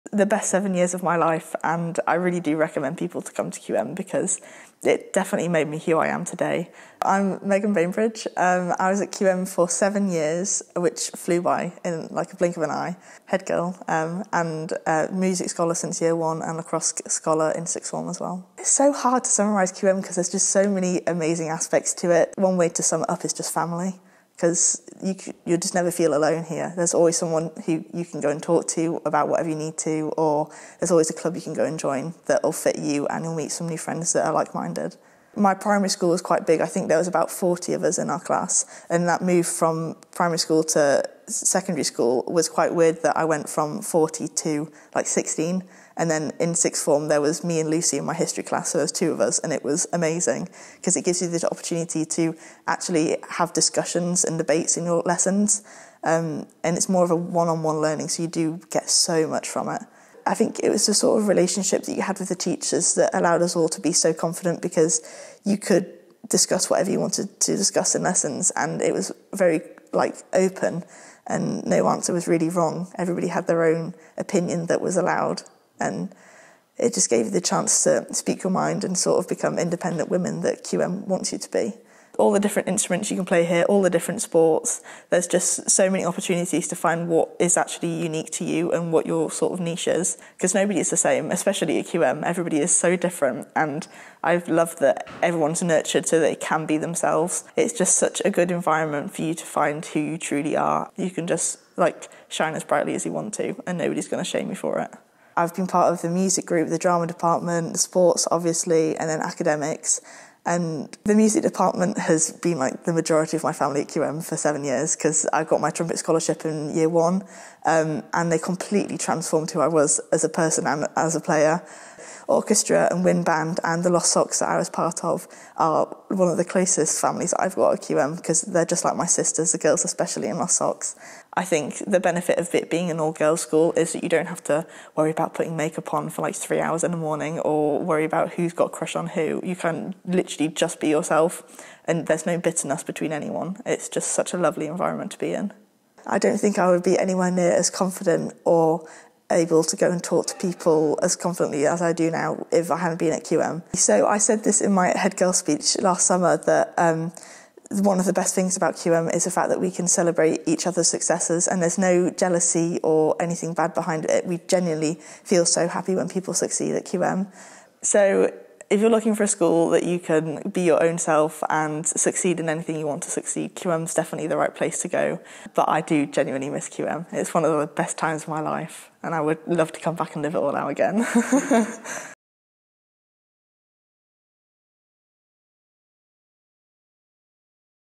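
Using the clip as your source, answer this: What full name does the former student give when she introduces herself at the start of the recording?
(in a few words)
Megan Bainbridge.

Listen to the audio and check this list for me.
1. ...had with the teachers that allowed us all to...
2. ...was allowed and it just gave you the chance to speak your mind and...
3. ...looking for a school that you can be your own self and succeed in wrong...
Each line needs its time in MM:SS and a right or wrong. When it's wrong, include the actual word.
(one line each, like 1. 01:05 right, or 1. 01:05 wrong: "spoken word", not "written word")
1. 01:02 right
2. 01:14 right
3. 02:48 wrong: "anything", not "wrong".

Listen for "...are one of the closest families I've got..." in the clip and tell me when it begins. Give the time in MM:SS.
02:05.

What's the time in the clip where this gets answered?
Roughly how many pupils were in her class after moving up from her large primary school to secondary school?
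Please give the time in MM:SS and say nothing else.
00:45.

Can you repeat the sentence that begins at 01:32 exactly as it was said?
Everybody is so different, and I've loved that everyone's nurtured so they can be themselves.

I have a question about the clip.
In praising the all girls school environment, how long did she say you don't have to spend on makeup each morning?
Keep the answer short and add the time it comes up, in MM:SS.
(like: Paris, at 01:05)
3 hours, at 02:16.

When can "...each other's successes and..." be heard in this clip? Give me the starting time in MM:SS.
02:40.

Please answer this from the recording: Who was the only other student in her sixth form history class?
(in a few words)
Lucy.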